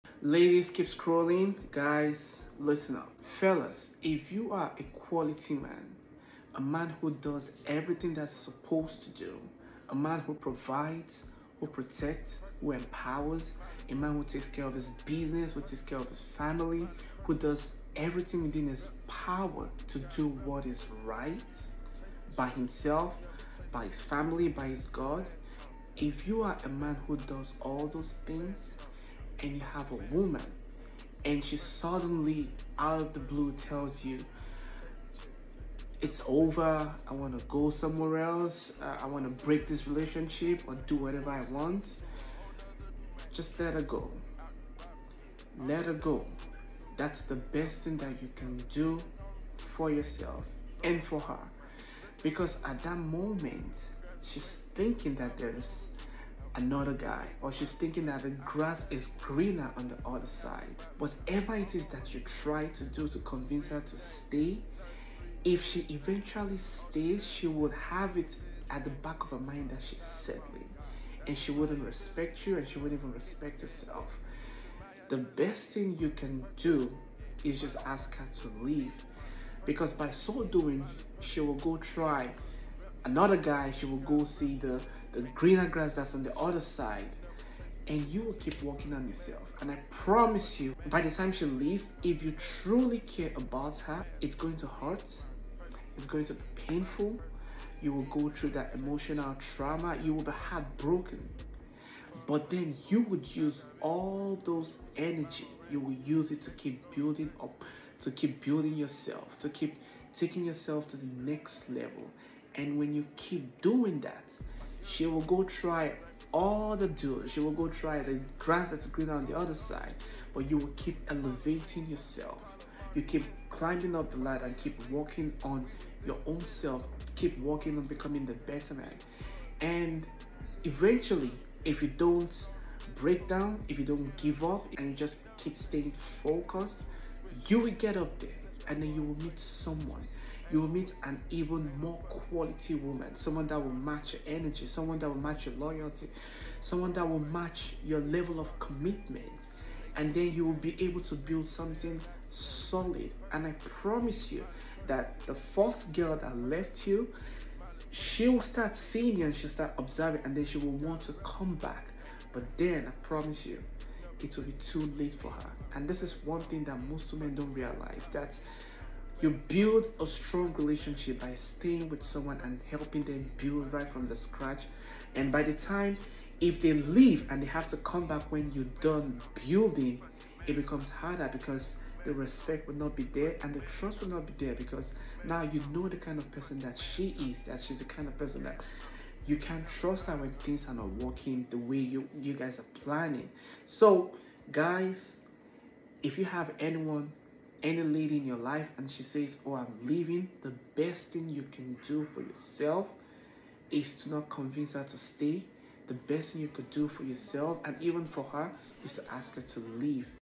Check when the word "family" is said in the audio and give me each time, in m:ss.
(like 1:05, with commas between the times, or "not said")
0:16, 0:24.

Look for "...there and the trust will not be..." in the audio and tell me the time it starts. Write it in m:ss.
3:03.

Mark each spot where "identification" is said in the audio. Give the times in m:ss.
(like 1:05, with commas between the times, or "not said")
not said.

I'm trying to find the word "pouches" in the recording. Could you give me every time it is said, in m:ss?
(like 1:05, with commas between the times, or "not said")
not said.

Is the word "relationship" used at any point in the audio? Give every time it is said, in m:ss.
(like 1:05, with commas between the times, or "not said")
0:39, 2:50.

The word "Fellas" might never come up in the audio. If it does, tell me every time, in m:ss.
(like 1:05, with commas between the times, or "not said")
0:03.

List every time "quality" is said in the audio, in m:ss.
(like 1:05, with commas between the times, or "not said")
0:04, 2:22.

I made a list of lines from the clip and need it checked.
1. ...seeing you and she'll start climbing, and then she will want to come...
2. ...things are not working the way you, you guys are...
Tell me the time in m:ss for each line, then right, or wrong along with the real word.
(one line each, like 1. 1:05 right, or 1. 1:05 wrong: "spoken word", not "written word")
1. 2:38 wrong: "observing", not "climbing"
2. 3:10 right.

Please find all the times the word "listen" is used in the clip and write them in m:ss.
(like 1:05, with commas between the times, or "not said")
0:02.